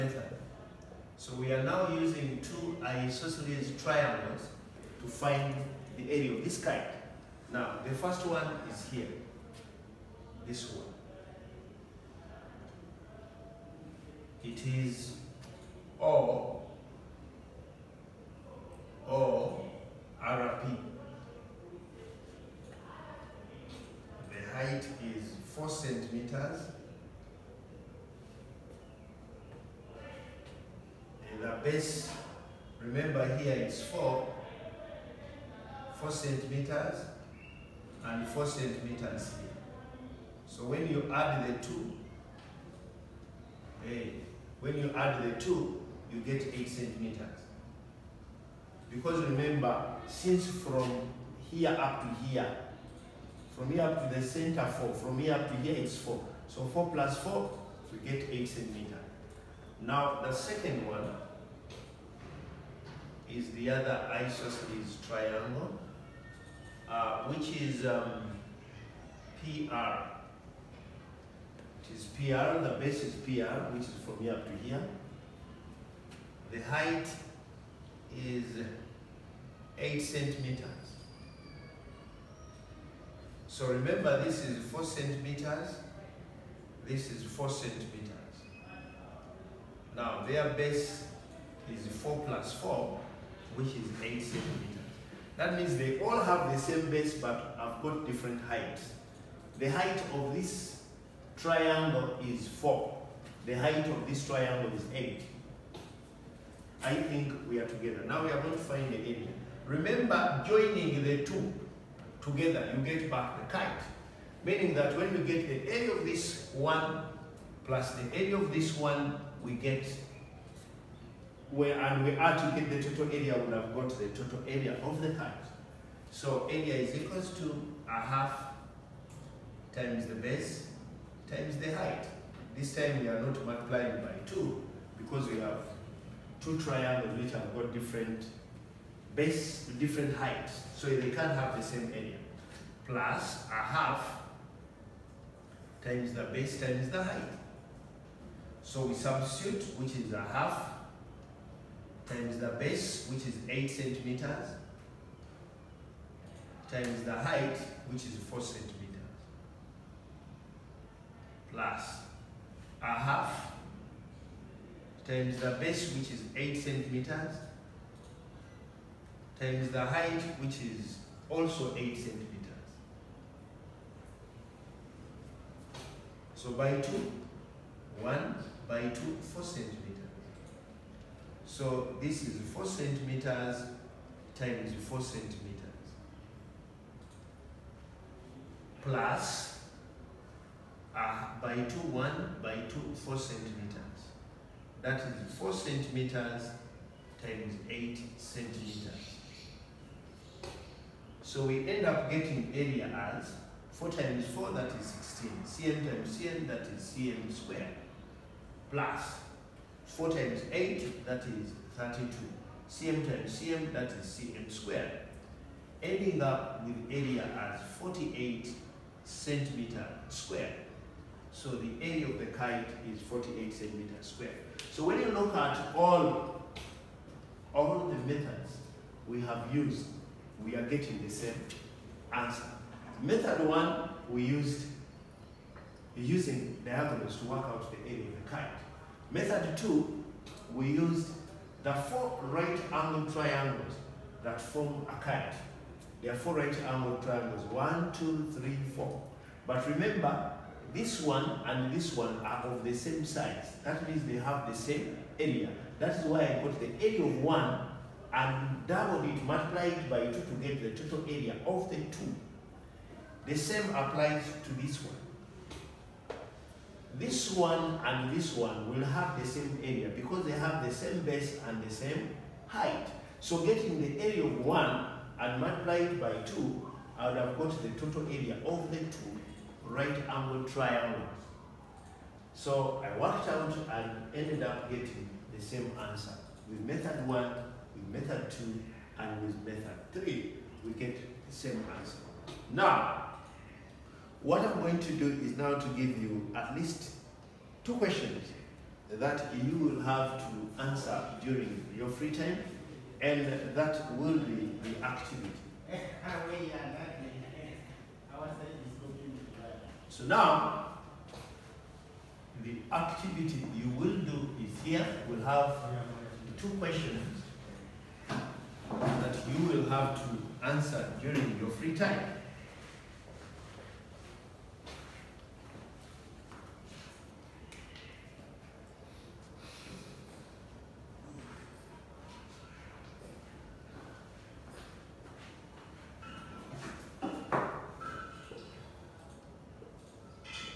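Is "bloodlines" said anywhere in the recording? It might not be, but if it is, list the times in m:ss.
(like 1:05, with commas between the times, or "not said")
not said.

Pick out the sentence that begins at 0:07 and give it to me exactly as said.
Now, the first one is here, this one.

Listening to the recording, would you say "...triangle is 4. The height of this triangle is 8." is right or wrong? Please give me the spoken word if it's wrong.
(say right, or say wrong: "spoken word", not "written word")
right.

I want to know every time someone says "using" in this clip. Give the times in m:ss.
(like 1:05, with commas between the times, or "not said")
0:01, 3:55.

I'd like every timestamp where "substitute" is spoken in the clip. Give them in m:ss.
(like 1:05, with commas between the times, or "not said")
2:28.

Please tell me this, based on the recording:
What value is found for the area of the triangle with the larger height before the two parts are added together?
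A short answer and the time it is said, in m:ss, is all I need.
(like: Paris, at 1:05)
32, at 3:31.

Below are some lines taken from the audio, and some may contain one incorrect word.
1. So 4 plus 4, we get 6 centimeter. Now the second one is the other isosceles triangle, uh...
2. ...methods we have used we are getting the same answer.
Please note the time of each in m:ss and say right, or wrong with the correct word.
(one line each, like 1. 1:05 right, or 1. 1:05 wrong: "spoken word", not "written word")
1. 0:56 wrong: "8", not "6"
2. 3:48 right.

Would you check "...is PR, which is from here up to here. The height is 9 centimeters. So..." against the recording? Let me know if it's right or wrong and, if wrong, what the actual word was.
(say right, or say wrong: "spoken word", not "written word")
wrong: "8", not "9".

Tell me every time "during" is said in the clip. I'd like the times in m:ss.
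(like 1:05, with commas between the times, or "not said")
5:01, 5:21.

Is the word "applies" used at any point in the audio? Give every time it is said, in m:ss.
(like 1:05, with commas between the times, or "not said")
4:23.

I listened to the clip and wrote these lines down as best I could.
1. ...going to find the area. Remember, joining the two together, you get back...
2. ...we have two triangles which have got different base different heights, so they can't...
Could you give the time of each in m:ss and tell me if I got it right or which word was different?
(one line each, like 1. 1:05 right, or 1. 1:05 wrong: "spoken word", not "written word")
1. 1:48 right
2. 2:15 right.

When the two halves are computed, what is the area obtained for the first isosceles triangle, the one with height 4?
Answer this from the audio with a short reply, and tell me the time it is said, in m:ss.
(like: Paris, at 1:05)
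16, at 3:24.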